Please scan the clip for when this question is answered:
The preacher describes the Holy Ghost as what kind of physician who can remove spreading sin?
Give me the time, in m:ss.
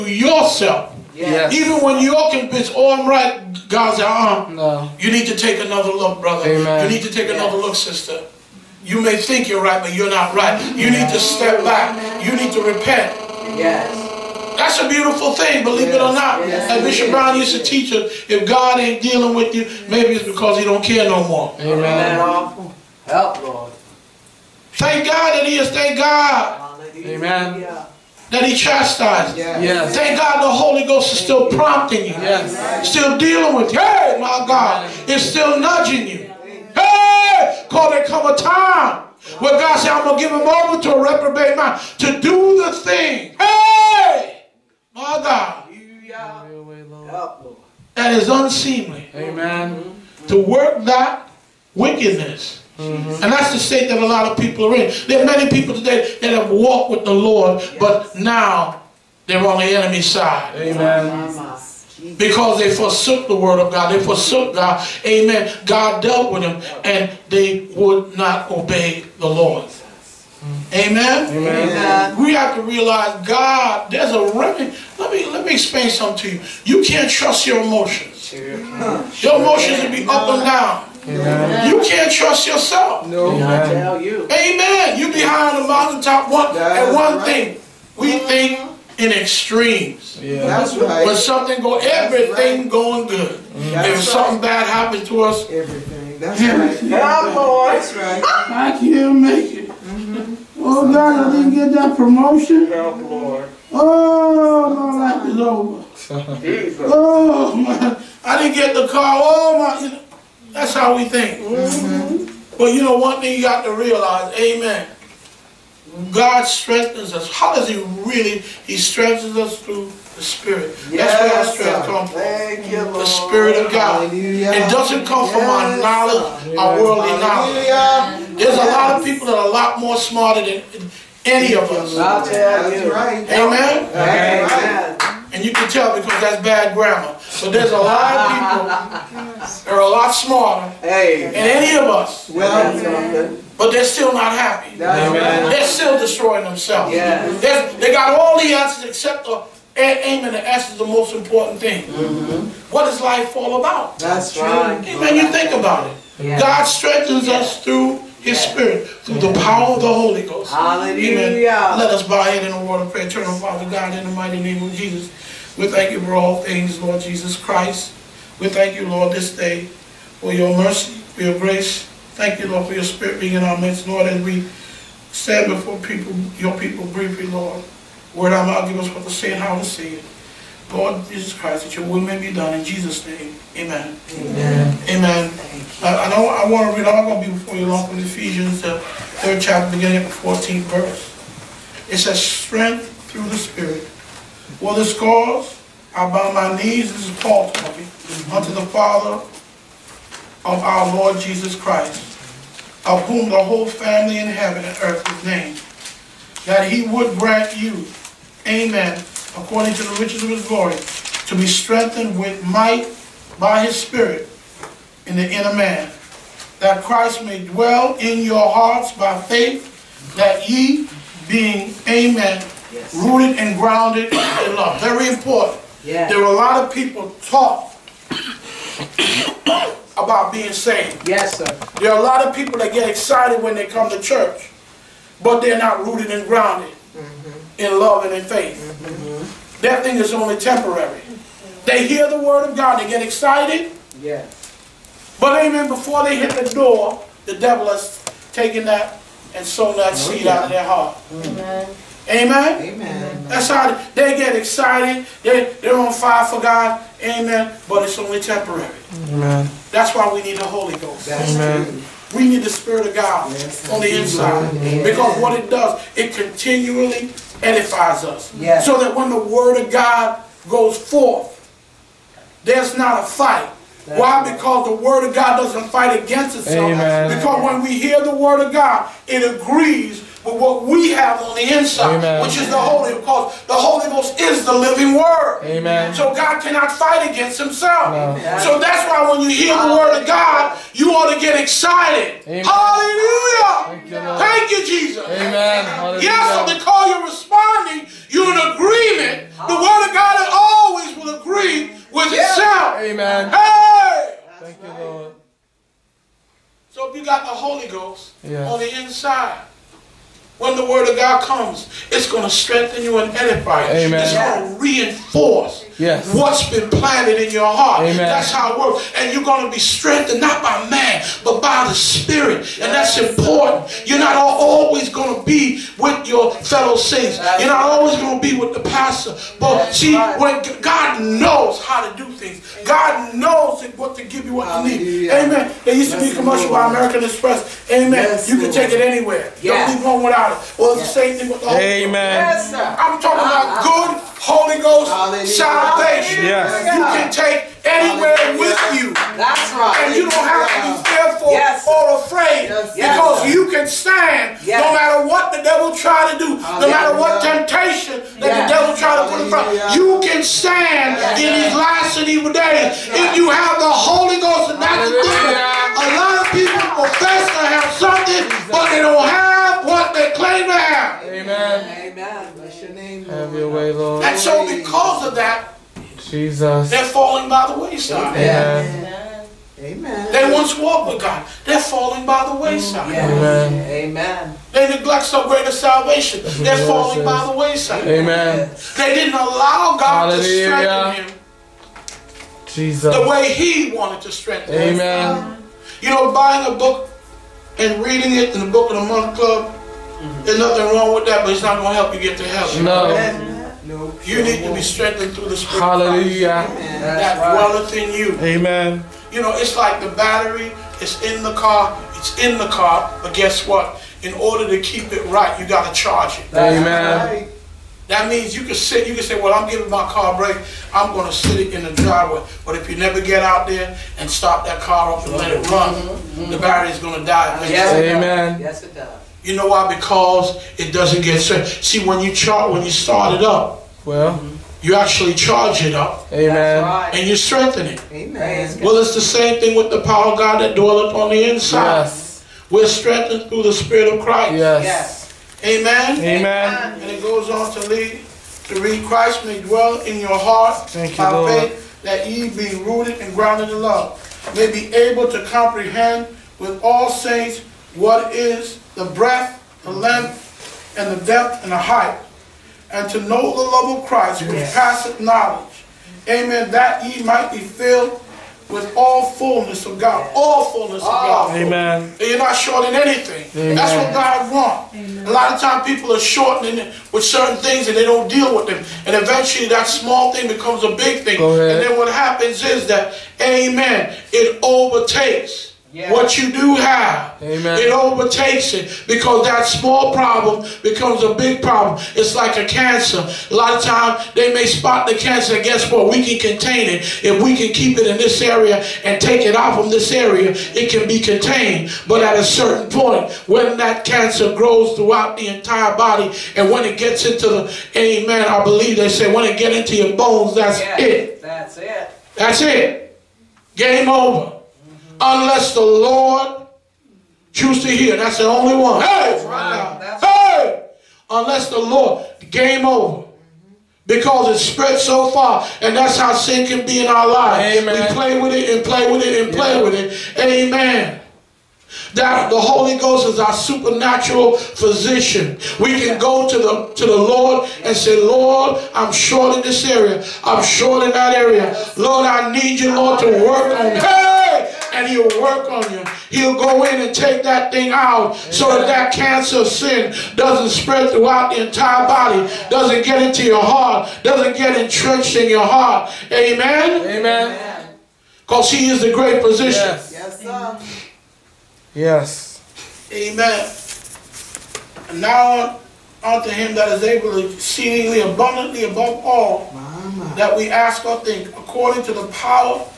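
8:53.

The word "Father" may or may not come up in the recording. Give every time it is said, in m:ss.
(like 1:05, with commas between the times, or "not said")
2:43, 3:18.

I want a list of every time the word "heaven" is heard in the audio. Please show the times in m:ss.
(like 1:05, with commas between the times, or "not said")
3:24, 6:42.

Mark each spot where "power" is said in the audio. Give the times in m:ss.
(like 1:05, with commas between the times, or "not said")
2:39, 7:19, 9:32.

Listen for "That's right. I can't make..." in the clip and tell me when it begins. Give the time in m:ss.
1:37.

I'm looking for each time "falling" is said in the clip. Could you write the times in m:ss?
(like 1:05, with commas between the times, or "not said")
6:16, 6:21, 6:26.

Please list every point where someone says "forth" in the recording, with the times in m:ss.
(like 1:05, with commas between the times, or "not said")
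4:30.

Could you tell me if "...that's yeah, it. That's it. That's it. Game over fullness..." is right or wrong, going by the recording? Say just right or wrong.
wrong.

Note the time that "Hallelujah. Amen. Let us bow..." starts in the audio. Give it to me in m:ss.
2:40.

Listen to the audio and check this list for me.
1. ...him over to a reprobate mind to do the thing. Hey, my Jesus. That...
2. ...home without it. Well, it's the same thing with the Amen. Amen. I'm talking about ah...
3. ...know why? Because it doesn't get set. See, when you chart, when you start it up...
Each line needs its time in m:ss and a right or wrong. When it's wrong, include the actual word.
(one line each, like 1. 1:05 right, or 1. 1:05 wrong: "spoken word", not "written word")
1. 0:40 wrong: "God", not "Jesus"
2. 5:39 right
3. 7:09 right.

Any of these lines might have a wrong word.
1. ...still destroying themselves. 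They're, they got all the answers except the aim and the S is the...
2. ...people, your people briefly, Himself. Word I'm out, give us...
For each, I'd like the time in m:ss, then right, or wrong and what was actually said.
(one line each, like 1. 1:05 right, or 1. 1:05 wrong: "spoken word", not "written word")
1. 2:25 right
2. 2:55 wrong: "Lord", not "Himself".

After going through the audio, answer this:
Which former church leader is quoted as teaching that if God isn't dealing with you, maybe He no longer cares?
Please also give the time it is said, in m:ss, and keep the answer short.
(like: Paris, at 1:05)
Bishop Brown, at 0:16.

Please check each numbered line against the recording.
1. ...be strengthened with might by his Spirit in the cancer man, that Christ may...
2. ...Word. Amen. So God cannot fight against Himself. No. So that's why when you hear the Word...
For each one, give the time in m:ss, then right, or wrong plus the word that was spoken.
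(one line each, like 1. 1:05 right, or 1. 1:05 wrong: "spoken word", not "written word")
1. 3:31 wrong: "inner", not "cancer"
2. 4:44 right.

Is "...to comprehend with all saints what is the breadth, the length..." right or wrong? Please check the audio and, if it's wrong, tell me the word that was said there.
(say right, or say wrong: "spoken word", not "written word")
right.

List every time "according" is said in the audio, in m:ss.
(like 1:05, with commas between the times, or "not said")
3:29, 9:31.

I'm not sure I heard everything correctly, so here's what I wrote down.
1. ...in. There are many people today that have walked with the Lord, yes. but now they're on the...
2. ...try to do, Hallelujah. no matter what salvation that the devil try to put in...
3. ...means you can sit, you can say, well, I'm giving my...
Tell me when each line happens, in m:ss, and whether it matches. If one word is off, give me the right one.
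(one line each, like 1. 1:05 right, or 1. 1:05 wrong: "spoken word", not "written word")
1. 0:54 right
2. 5:55 wrong: "temptation", not "salvation"
3. 6:58 right.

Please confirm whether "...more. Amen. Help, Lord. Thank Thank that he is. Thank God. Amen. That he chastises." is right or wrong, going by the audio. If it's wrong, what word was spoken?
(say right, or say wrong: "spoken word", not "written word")
wrong: "God", not "Thank".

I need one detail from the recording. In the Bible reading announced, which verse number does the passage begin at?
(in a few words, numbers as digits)
14.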